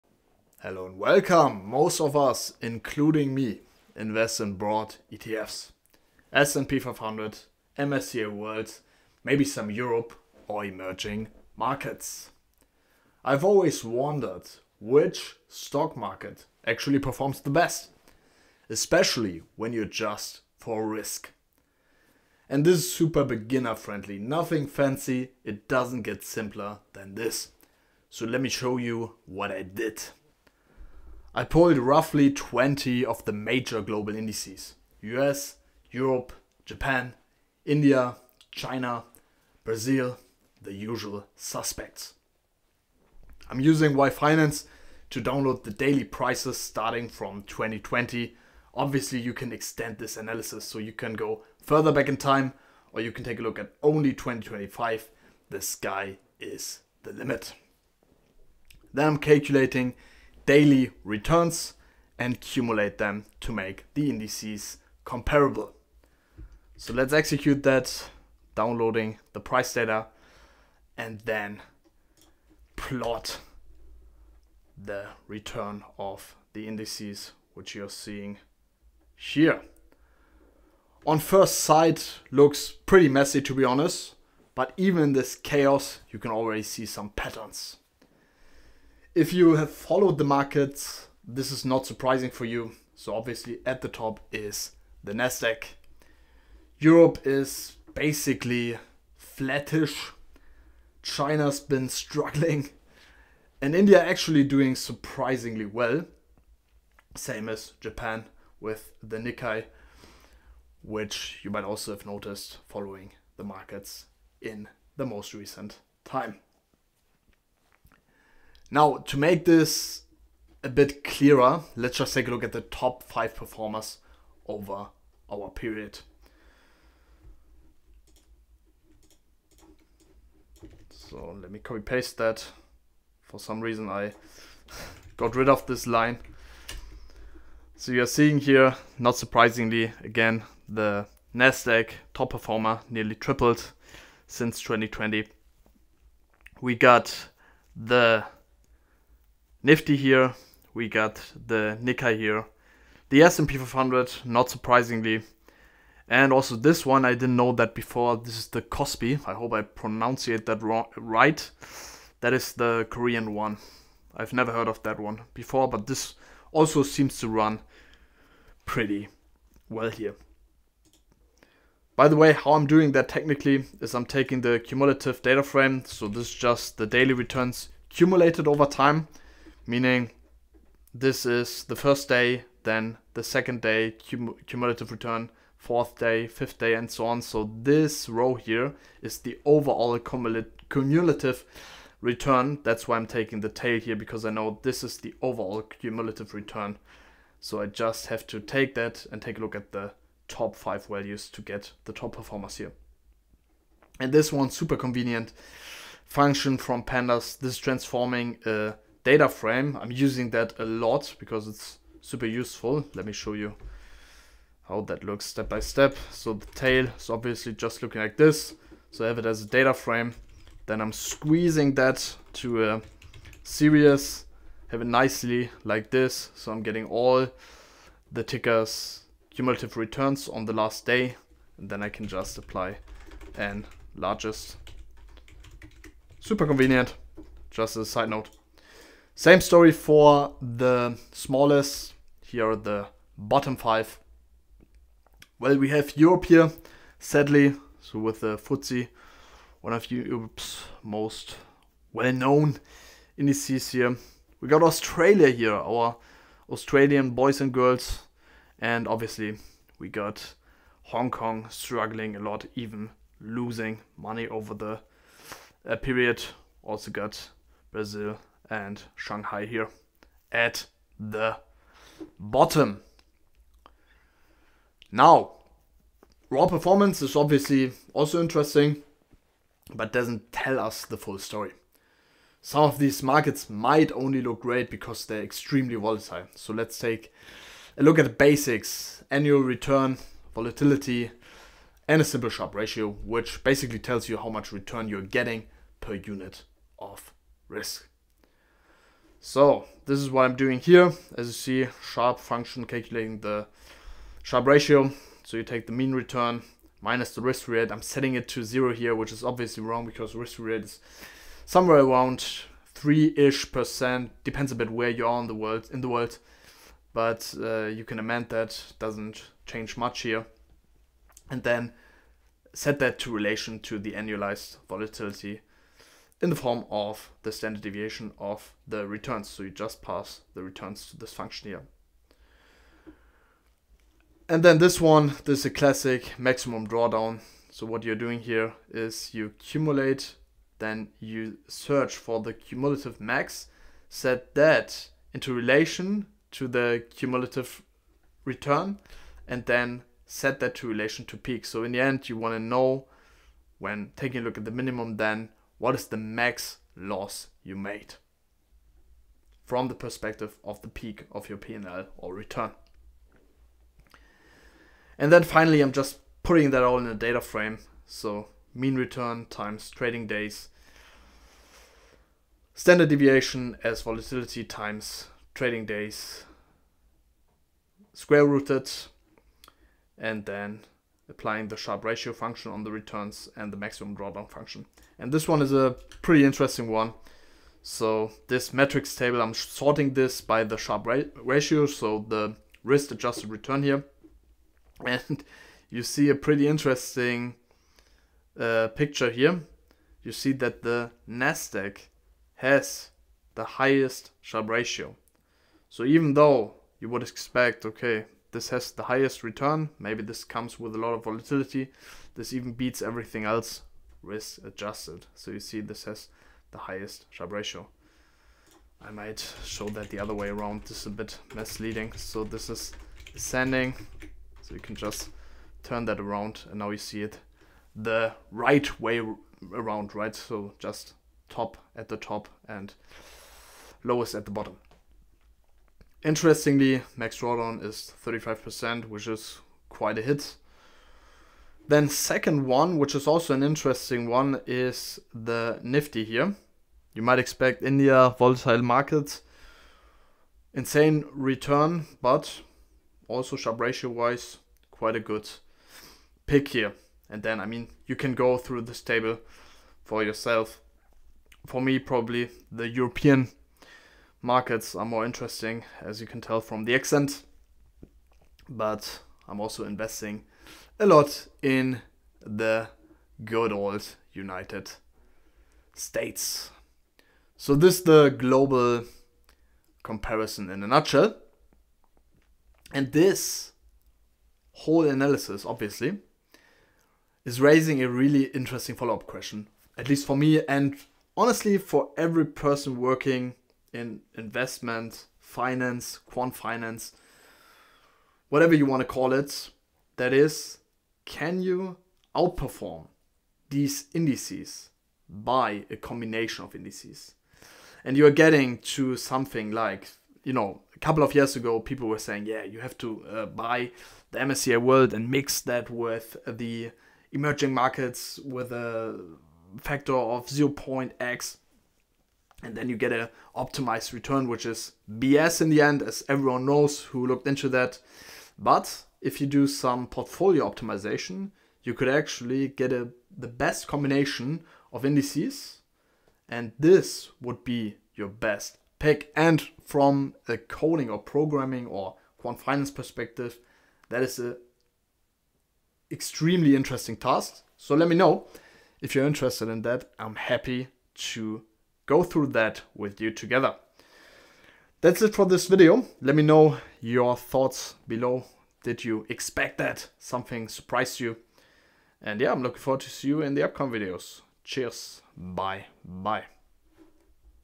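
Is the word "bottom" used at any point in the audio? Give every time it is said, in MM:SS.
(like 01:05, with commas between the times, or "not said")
04:03, 04:32, 07:14.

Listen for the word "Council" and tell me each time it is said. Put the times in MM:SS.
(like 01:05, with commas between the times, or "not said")
not said.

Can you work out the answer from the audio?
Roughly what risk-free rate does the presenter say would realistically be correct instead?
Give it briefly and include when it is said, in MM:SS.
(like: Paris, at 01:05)
3%, at 05:12.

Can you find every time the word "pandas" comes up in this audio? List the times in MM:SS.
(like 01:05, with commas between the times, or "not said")
03:26.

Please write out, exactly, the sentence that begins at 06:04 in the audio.
And then finally, I'm just putting that all in a data frame.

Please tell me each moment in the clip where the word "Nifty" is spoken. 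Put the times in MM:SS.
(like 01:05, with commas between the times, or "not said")
02:29, 07:25.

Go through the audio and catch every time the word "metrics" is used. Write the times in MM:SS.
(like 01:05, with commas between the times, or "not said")
06:28.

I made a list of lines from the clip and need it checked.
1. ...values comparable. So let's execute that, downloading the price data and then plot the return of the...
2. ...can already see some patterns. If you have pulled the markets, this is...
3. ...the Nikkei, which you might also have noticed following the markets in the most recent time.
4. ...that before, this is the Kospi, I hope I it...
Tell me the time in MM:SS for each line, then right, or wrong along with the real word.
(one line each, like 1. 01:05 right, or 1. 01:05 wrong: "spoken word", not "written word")
1. 01:04 wrong: "indices", not "values"
2. 01:26 wrong: "followed", not "pulled"
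3. 01:49 right
4. 02:37 right.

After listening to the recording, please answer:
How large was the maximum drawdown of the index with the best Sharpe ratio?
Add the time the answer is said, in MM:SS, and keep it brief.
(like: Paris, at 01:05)
35%, at 07:18.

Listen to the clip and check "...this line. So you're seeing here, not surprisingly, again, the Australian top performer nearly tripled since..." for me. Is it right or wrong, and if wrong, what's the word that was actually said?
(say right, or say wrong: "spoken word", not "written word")
wrong: "NASDAQ", not "Australian".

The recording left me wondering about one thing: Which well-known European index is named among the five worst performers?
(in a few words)
FTSE.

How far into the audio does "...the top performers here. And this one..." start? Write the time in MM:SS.
03:21.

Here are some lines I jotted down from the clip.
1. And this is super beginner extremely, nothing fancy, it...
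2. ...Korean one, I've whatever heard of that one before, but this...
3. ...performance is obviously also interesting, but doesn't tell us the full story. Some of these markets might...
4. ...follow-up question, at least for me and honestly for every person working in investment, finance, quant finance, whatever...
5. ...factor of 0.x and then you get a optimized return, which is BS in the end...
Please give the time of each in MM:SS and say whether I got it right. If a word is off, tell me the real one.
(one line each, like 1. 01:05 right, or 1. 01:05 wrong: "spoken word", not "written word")
1. 00:22 wrong: "friendly", not "extremely"
2. 02:42 wrong: "never", not "whatever"
3. 04:36 right
4. 08:08 right
5. 08:39 right.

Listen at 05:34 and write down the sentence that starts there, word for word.
And then this one, this is a classic maximum drawdown.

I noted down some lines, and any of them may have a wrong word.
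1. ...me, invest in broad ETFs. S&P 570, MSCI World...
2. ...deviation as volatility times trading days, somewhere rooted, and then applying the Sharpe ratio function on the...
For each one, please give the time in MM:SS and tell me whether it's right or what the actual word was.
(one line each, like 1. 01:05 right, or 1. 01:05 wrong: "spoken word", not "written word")
1. 00:03 wrong: "500", not "570"
2. 06:12 wrong: "square", not "somewhere".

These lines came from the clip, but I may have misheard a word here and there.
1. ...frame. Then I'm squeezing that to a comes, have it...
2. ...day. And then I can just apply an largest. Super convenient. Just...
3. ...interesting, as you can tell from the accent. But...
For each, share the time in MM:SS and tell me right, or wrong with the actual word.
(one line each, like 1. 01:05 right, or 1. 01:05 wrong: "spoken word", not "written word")
1. 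03:39 wrong: "series", not "comes"
2. 03:50 right
3. 07:45 right.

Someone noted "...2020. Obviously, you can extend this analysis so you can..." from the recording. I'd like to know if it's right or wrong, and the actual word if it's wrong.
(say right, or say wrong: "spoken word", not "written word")
right.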